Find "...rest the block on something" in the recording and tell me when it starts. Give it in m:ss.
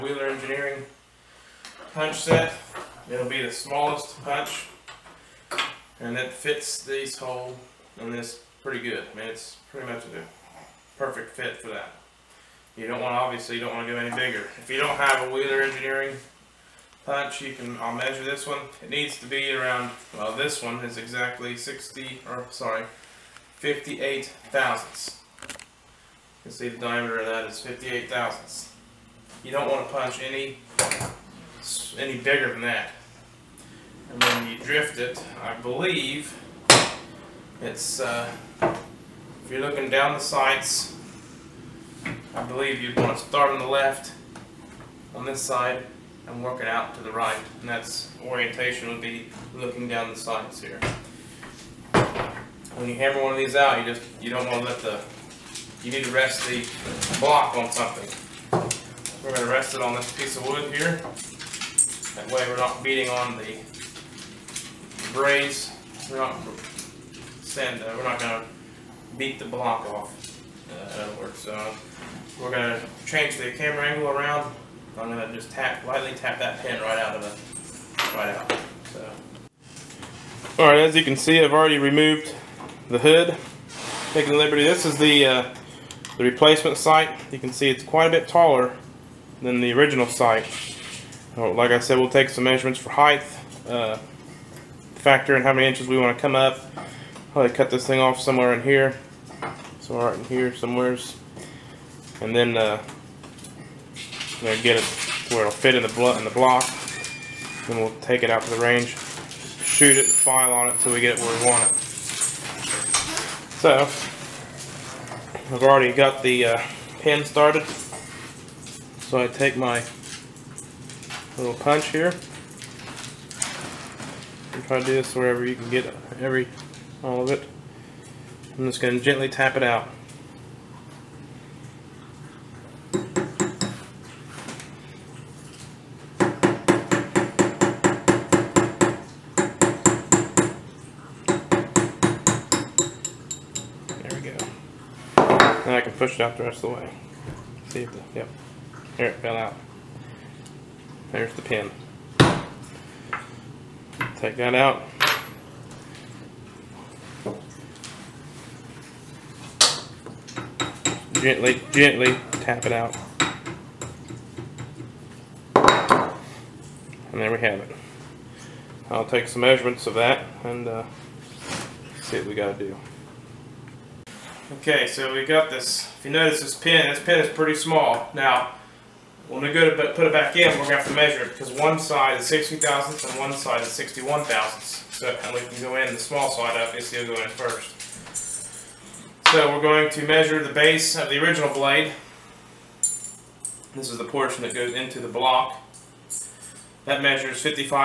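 0:56.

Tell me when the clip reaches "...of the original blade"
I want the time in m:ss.
3:10.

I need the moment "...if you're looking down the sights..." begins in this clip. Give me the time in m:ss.
0:38.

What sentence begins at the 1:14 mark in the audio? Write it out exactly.
I'm gonna just tap lightly tap that pin right out of it, right out.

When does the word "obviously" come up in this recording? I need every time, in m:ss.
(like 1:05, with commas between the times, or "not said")
0:13.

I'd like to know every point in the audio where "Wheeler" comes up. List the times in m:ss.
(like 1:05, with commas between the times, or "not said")
0:00, 0:15.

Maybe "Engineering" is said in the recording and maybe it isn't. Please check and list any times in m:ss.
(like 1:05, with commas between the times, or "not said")
0:00, 0:15.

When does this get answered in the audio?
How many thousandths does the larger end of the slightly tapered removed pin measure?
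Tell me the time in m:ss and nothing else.
3:03.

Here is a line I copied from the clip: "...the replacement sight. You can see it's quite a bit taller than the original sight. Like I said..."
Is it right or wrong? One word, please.
right.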